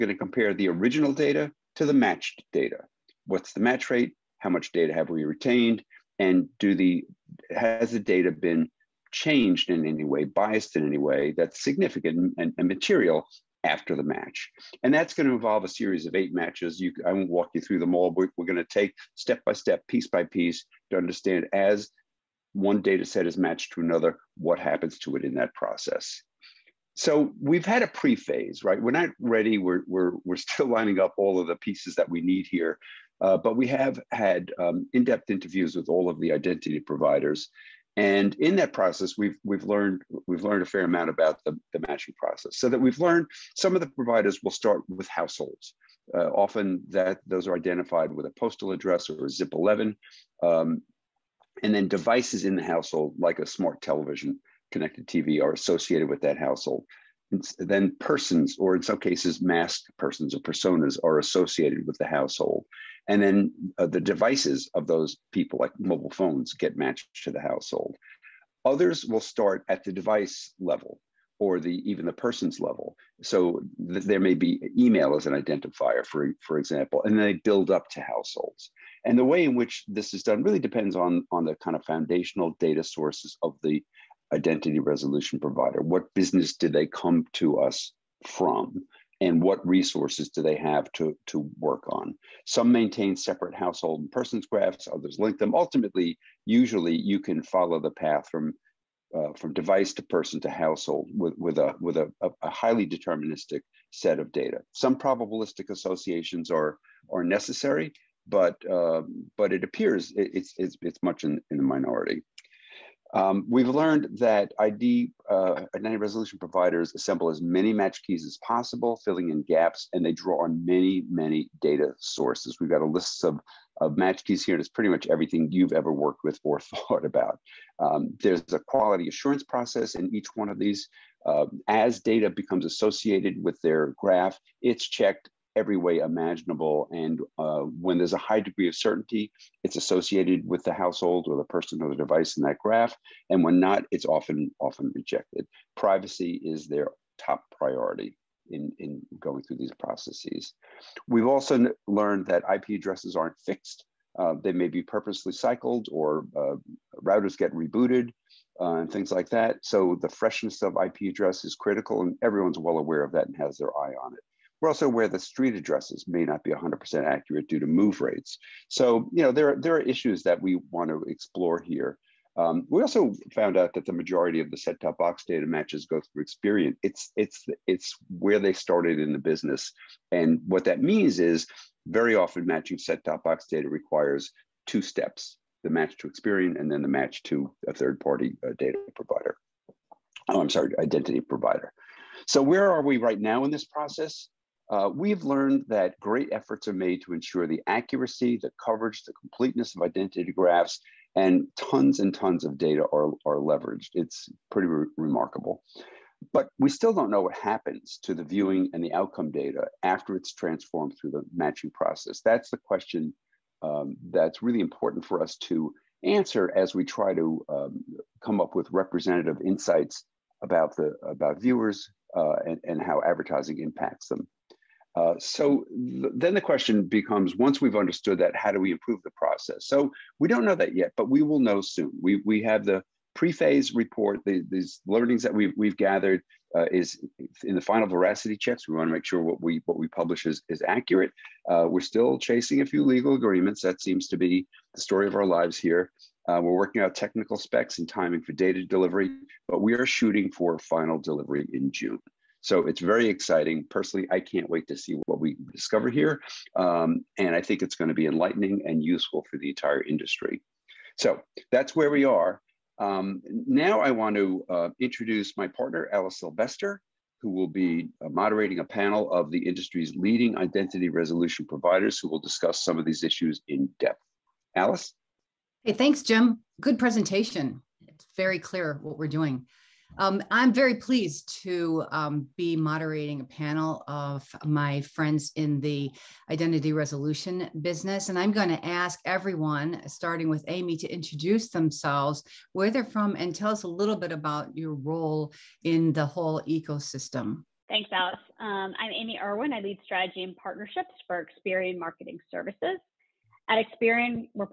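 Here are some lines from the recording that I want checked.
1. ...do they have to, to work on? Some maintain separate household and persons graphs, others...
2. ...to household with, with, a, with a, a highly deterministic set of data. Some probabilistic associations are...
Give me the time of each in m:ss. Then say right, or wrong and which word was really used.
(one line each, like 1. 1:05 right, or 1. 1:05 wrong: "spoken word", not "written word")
1. 1:30 right
2. 1:40 right.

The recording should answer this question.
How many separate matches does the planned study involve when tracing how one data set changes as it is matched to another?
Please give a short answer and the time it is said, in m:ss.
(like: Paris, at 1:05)
8, at 0:16.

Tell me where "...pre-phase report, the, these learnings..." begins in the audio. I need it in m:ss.
3:53.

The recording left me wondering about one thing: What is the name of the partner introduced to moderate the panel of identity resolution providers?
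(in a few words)
Alice Sylvester.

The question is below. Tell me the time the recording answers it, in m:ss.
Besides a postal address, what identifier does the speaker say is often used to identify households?
0:49.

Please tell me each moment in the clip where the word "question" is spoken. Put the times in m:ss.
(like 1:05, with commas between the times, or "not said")
3:32, 3:46.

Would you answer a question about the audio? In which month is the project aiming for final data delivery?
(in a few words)
June.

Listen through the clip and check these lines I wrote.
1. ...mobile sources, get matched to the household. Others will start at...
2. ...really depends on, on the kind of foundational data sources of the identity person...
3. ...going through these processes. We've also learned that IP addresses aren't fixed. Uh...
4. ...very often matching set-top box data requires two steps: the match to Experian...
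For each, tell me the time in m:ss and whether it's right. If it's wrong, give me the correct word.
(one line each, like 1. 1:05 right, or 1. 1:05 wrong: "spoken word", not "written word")
1. 1:05 wrong: "phones", not "sources"
2. 1:20 wrong: "resolution", not "person"
3. 2:29 right
4. 3:01 right.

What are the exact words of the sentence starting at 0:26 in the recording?
So we've had a pre-phase, right?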